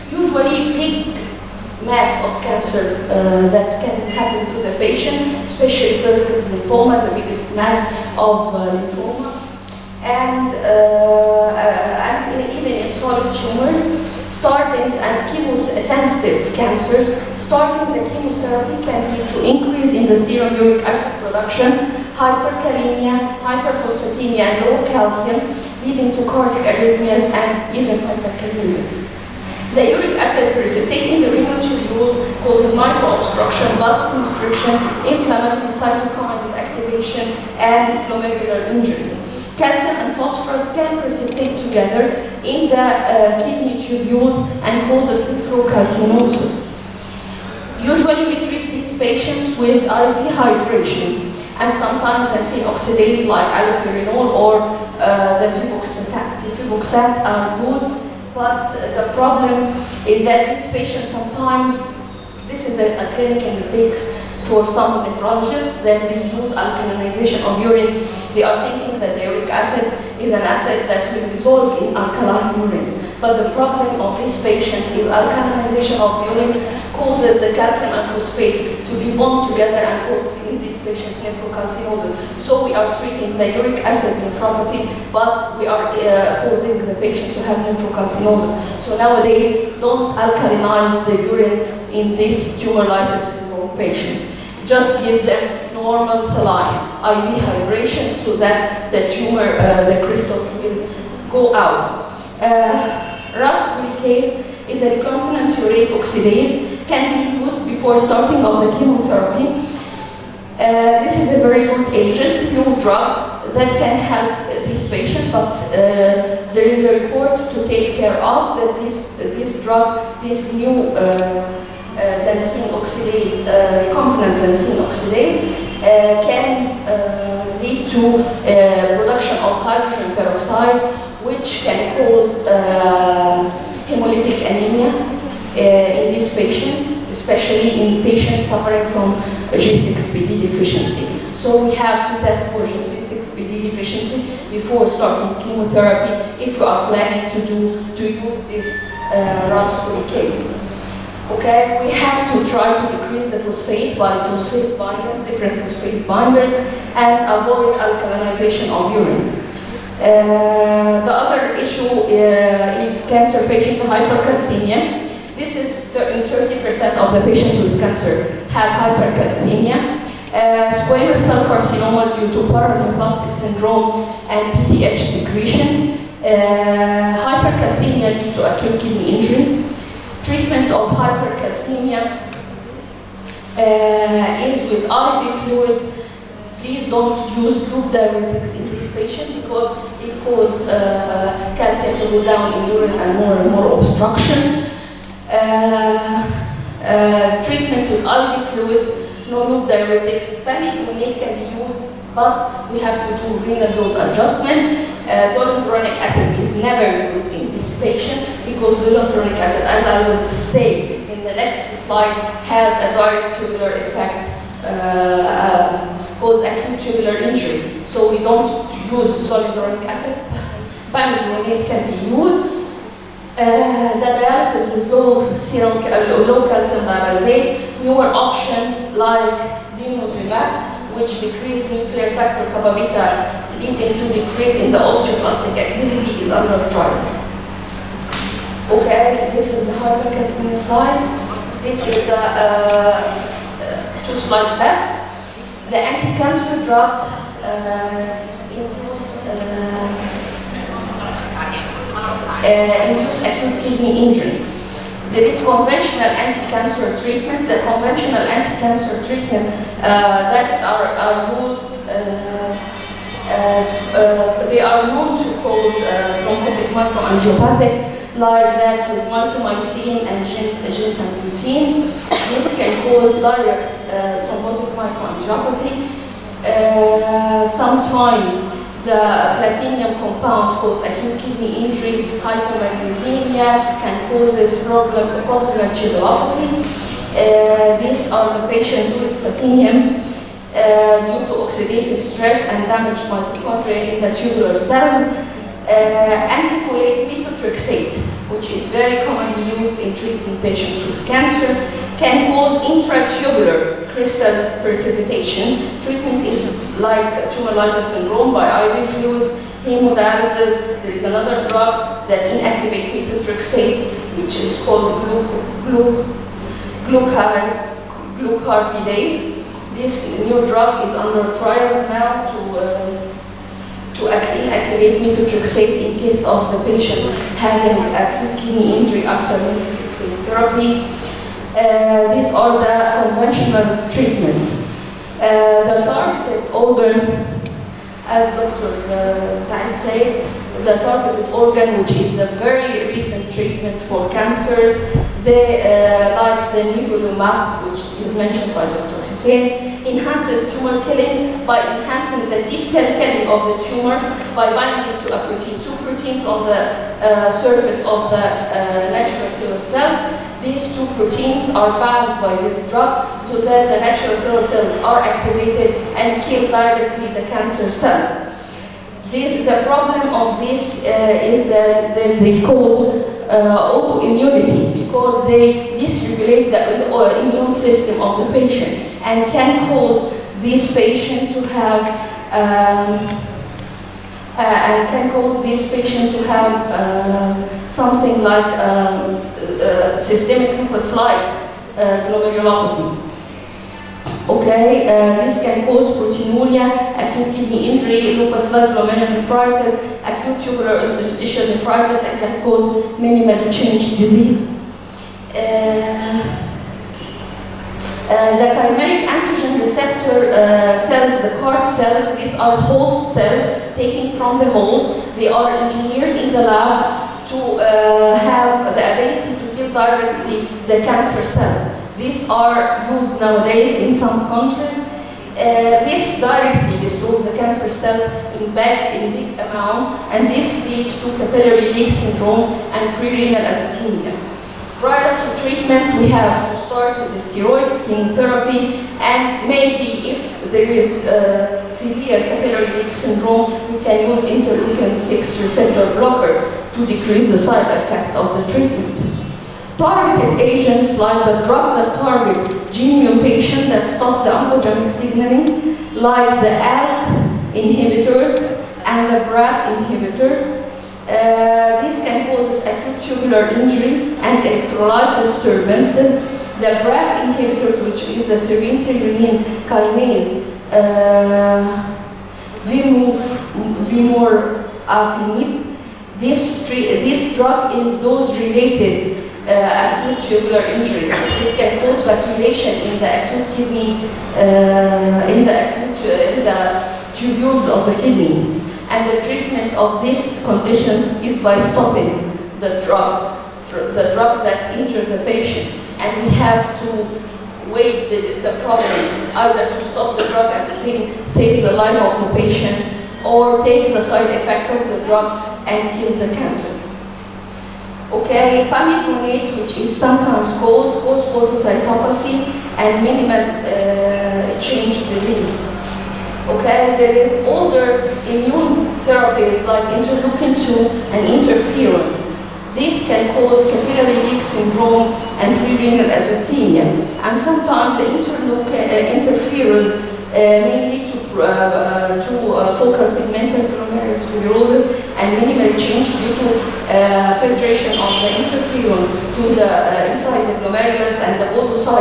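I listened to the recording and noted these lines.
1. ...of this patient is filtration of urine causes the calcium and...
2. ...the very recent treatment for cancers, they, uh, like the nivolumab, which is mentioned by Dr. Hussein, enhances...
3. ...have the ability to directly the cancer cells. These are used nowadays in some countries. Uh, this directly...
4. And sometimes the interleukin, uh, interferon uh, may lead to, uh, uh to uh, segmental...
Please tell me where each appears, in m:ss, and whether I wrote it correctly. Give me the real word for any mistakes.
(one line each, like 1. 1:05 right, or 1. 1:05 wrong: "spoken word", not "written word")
1. 1:14 wrong: "alkalization", not "filtration"
2. 5:42 right
3. 6:58 right
4. 8:47 wrong: "focal", not "segmental".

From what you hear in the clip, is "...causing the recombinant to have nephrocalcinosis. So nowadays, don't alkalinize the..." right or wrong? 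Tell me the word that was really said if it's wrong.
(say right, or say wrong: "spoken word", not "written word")
wrong: "patient", not "recombinant".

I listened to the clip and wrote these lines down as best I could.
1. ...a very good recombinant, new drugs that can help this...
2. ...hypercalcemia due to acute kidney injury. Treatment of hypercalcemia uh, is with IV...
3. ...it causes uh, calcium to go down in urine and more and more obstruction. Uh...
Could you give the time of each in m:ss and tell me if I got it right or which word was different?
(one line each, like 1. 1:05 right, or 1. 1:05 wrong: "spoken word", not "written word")
1. 1:51 wrong: "agent", not "recombinant"
2. 2:57 right
3. 3:10 right.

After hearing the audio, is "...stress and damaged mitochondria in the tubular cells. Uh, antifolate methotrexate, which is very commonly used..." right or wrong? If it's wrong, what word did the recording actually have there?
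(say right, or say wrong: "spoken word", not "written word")
right.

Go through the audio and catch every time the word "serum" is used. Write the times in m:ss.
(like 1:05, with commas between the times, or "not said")
0:20, 3:45.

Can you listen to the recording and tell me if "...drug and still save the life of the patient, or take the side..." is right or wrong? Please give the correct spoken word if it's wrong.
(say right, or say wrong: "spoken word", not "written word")
right.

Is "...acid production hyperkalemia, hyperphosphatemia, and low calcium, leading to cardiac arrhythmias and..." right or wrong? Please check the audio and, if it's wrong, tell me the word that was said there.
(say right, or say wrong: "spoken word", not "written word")
right.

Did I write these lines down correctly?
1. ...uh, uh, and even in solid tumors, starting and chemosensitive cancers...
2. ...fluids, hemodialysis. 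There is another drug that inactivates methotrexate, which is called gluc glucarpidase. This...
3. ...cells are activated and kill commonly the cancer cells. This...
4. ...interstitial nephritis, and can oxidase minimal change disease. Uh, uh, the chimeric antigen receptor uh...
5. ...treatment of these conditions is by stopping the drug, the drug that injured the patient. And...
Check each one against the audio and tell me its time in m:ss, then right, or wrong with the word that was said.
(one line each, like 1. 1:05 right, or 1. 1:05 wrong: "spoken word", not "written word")
1. 0:10 right
2. 5:08 right
3. 6:04 wrong: "directly", not "commonly"
4. 6:40 wrong: "cause", not "oxidase"
5. 8:09 right.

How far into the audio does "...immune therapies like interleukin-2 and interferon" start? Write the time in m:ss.
8:38.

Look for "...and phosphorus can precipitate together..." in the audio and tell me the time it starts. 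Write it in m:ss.
0:40.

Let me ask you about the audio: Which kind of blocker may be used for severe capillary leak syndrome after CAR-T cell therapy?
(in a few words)
Interleukin 6 receptor blocker.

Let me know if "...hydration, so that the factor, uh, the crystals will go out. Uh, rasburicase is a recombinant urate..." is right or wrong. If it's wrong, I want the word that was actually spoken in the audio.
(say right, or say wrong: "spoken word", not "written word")
wrong: "tumor", not "factor".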